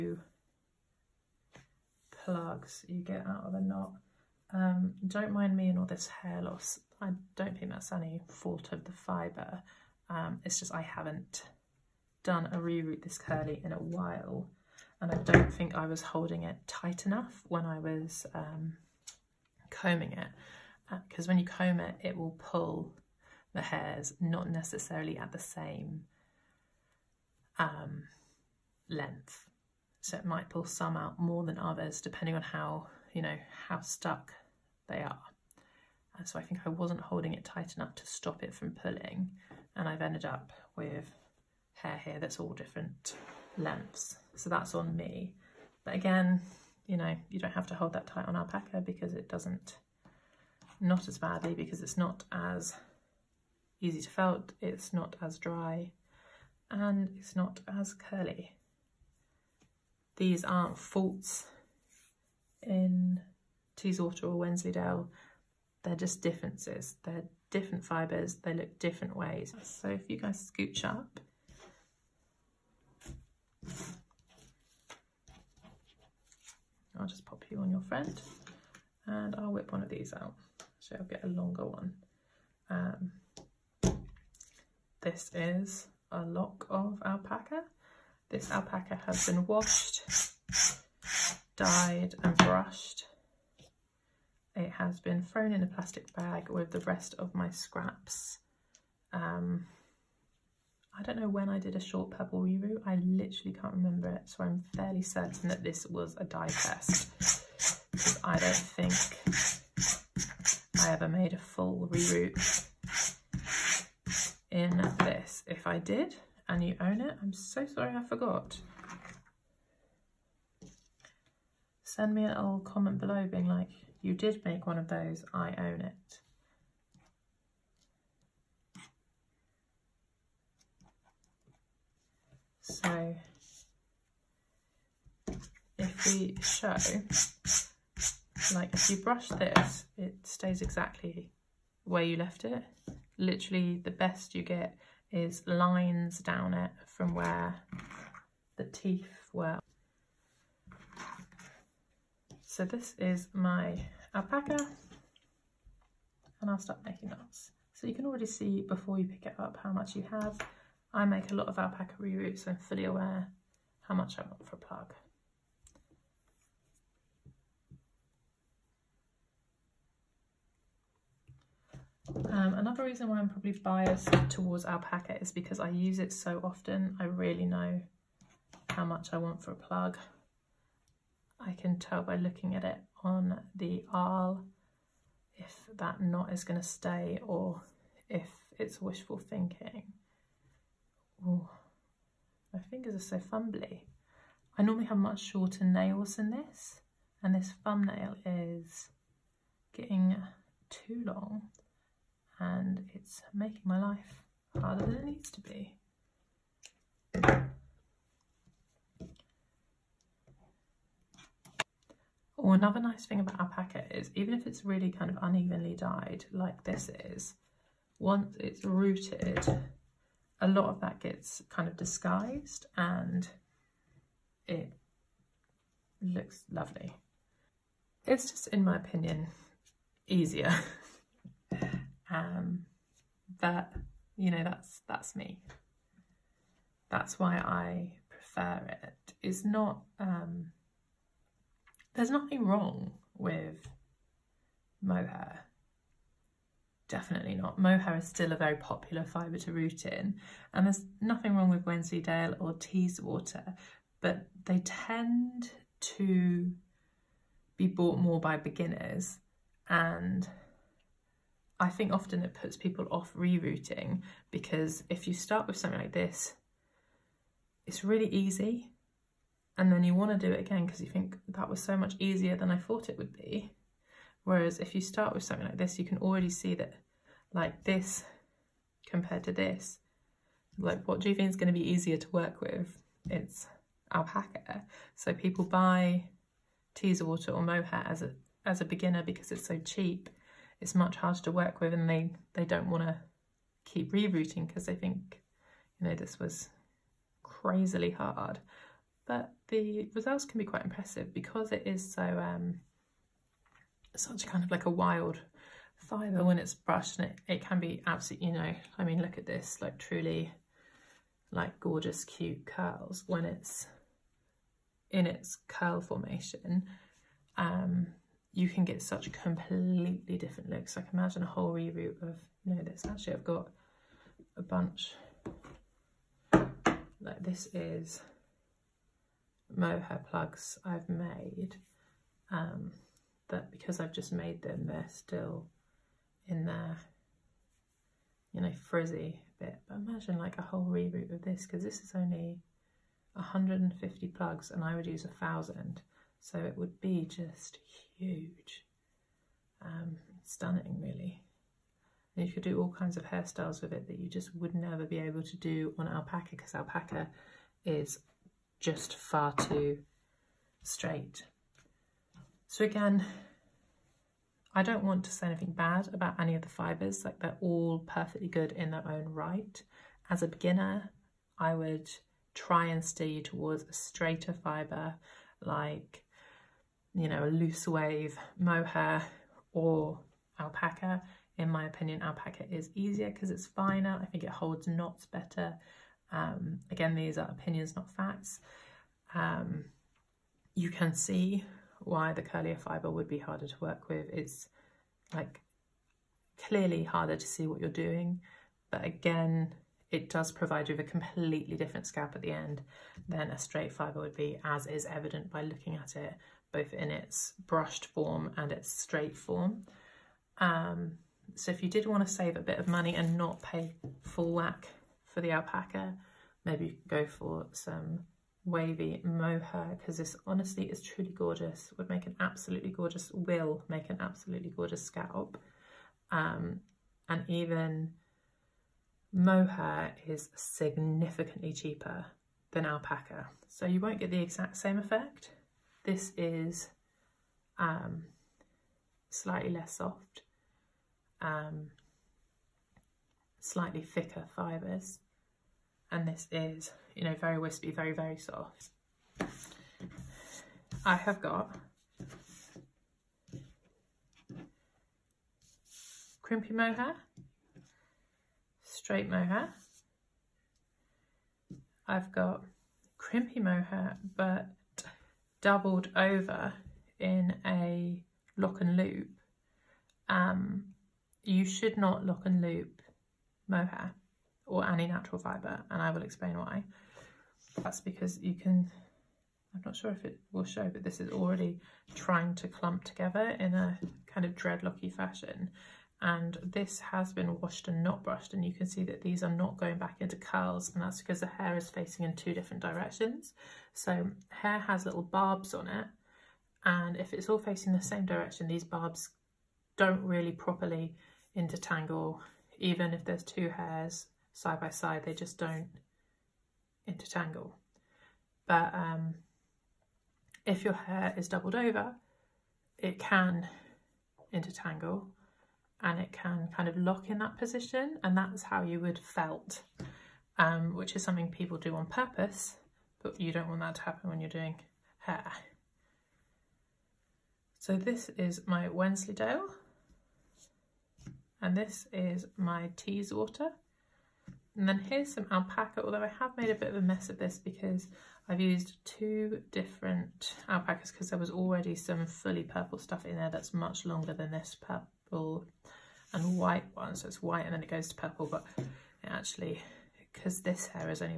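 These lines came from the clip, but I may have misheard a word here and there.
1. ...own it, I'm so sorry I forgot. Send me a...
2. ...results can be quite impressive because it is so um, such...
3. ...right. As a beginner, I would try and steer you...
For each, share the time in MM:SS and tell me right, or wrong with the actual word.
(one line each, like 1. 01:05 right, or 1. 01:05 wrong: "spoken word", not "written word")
1. 01:56 right
2. 04:59 right
3. 06:09 right.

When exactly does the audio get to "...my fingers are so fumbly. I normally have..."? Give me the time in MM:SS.
03:12.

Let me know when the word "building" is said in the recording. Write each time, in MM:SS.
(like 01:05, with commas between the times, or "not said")
not said.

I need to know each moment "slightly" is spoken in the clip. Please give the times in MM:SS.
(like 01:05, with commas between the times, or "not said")
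07:19, 07:23.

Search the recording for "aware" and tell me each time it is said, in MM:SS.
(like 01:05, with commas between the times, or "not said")
02:42.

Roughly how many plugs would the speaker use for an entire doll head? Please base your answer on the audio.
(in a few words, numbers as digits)
1000.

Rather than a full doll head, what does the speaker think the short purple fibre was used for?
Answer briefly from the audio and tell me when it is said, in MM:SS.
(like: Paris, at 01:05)
A dye test, at 01:46.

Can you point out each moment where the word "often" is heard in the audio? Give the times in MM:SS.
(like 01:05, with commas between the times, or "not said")
02:56, 04:21.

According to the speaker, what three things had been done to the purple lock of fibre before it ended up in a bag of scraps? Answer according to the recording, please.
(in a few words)
Washed, dyed and brushed.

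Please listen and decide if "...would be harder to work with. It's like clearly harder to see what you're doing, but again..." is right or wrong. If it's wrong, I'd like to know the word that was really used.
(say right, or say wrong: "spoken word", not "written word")
right.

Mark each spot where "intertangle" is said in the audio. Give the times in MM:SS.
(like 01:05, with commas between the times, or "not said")
08:21, 08:26, 08:34.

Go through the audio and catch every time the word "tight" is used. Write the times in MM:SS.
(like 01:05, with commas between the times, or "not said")
00:16, 00:37, 00:48.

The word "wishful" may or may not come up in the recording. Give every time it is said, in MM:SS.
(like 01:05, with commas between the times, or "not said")
03:08.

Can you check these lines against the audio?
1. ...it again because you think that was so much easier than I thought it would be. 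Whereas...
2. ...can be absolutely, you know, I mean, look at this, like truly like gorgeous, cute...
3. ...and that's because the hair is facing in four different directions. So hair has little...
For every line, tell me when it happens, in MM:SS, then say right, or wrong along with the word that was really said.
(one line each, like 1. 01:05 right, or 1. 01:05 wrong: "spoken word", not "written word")
1. 04:30 right
2. 05:07 right
3. 08:10 wrong: "two", not "four".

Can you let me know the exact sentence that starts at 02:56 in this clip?
I really know how much I want for a plug.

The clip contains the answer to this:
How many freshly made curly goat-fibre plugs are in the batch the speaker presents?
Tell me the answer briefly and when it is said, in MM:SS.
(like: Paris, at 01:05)
150, at 05:43.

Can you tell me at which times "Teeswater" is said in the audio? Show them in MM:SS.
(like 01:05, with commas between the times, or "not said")
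01:03, 04:12, 04:46, 08:52.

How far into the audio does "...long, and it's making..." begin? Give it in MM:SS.
03:21.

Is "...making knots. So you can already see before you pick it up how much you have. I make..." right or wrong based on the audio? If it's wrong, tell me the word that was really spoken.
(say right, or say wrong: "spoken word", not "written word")
right.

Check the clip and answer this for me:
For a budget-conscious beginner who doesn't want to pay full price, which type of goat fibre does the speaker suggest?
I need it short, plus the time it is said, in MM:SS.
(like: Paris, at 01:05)
Wavy mohair, at 06:58.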